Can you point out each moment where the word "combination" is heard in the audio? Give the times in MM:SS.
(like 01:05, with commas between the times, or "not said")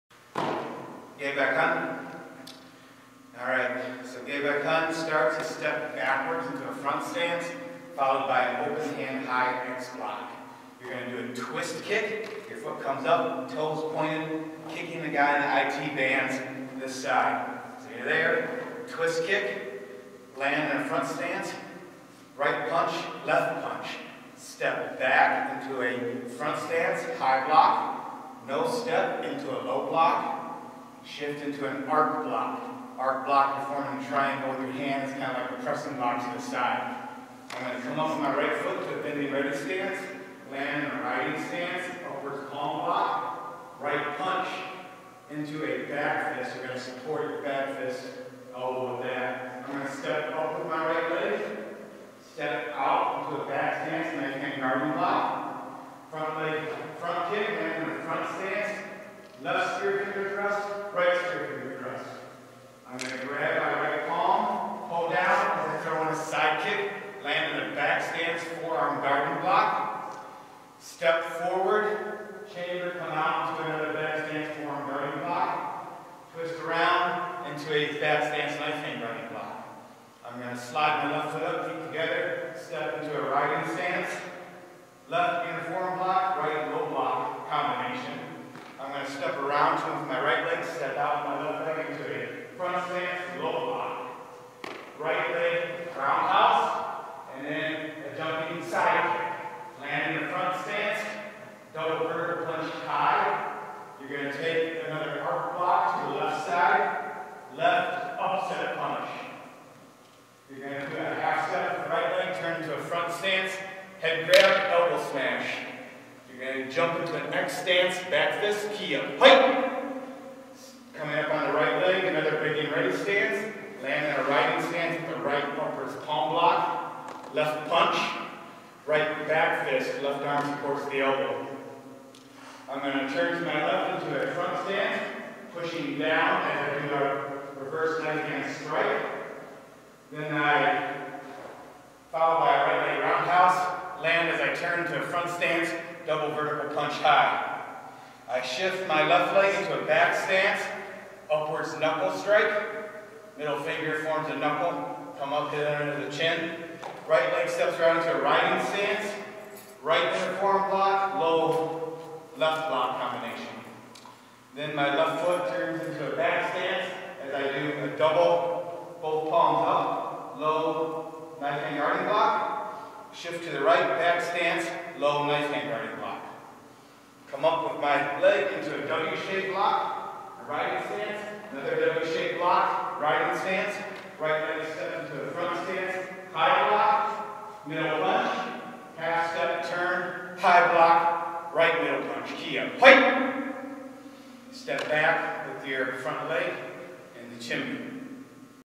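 01:27, 02:42.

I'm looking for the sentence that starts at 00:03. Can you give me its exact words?
All right, so Ge Baek hyung starts a step backwards into a front stance, followed by an open hand high X block.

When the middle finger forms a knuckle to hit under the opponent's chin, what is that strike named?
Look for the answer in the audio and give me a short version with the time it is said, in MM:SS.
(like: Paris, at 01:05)
Upwards knuckle strike, at 02:31.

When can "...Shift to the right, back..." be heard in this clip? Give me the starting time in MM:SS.
02:53.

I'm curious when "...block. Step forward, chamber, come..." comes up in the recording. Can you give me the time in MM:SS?
01:09.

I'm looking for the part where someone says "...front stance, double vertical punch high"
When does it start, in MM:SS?
02:25.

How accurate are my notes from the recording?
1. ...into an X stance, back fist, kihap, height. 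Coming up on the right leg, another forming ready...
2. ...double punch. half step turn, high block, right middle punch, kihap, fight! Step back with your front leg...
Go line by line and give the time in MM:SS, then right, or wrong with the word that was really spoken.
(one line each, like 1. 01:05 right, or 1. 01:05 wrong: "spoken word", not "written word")
1. 01:56 wrong: "bending", not "forming"
2. 03:07 wrong: "middle", not "double".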